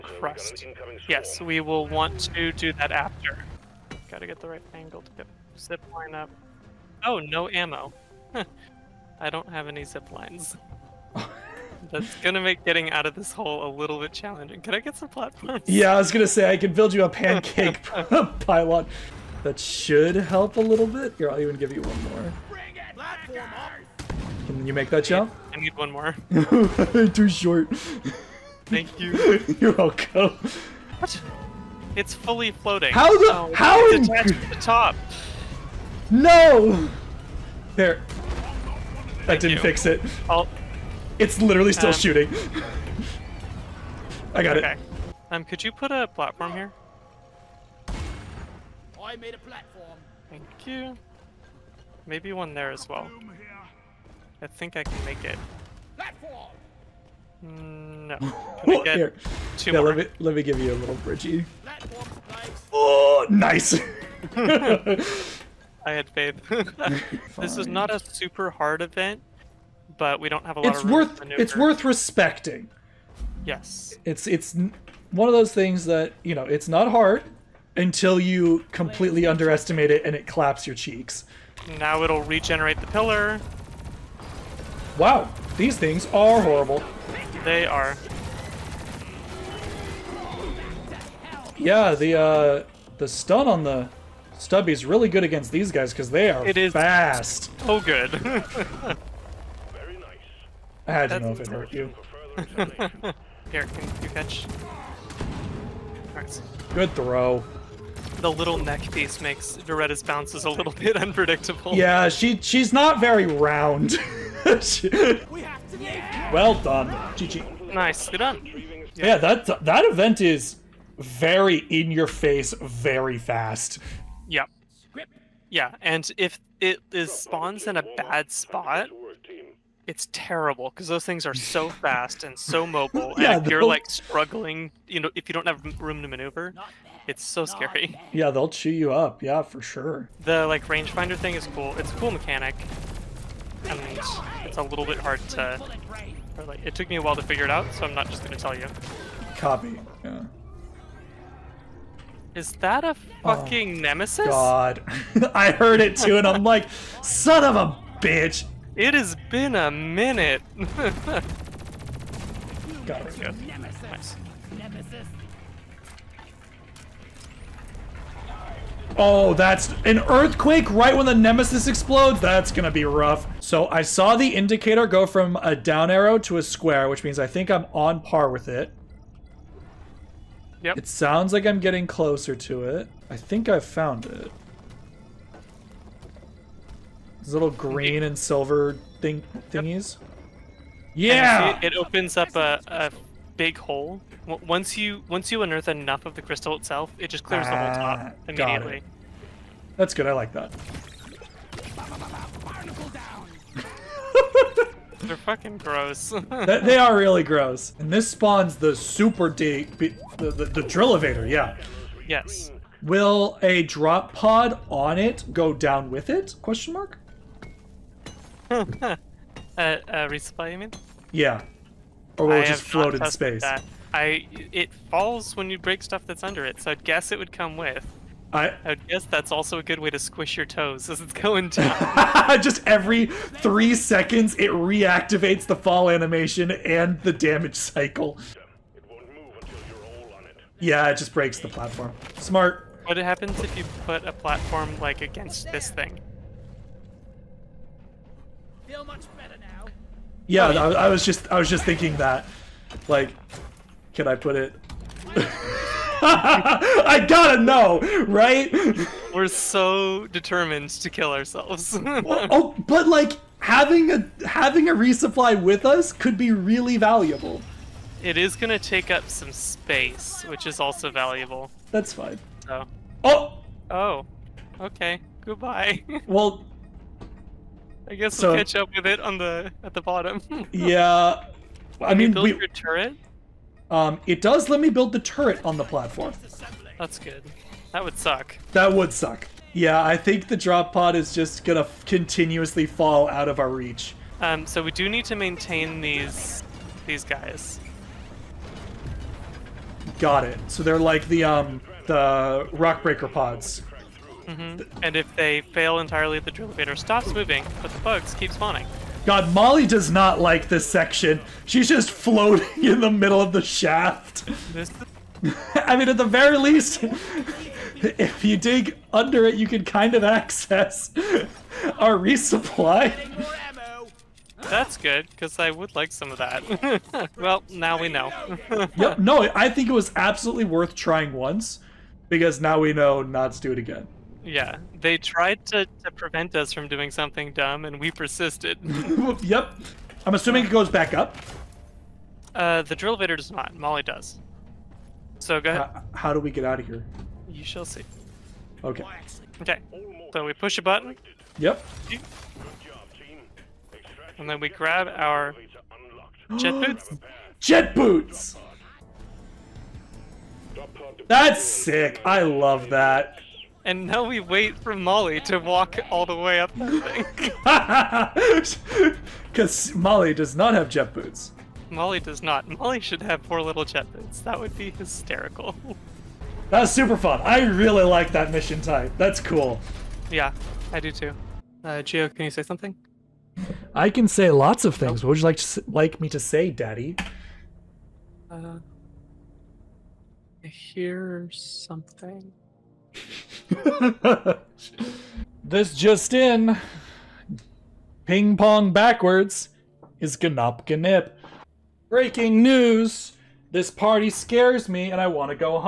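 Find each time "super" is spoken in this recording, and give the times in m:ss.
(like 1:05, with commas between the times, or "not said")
1:07, 3:28, 6:16.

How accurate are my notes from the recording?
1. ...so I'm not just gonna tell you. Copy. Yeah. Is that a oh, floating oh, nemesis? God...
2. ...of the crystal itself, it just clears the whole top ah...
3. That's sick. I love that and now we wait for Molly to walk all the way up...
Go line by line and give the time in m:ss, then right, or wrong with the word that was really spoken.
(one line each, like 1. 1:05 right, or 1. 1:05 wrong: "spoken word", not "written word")
1. 2:27 wrong: "fucking", not "floating"
2. 3:16 right
3. 6:01 right.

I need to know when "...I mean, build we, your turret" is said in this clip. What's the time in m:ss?
4:41.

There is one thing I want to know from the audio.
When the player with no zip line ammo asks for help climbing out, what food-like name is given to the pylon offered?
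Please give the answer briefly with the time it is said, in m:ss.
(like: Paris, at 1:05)
pancake, at 0:17.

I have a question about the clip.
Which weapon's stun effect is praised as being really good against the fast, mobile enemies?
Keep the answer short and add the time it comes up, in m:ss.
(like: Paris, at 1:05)
the stubby, at 1:34.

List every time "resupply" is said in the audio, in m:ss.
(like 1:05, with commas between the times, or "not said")
3:39, 4:24, 5:21.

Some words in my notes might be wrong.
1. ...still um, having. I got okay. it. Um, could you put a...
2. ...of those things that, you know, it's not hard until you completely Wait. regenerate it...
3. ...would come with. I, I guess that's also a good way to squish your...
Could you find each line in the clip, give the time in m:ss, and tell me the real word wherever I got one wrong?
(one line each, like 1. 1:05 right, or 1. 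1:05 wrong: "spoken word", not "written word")
1. 0:41 wrong: "shooting", not "having"
2. 1:15 wrong: "underestimate", not "regenerate"
3. 3:47 right.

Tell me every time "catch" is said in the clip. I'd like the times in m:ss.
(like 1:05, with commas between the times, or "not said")
1:44, 4:38.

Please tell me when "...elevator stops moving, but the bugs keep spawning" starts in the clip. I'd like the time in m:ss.
5:06.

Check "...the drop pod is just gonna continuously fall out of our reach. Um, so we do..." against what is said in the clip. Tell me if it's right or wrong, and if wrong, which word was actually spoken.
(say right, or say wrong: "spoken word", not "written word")
right.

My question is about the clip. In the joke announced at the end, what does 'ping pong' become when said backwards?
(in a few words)
Ganop.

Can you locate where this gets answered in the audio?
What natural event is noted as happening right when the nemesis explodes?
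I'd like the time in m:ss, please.
2:50.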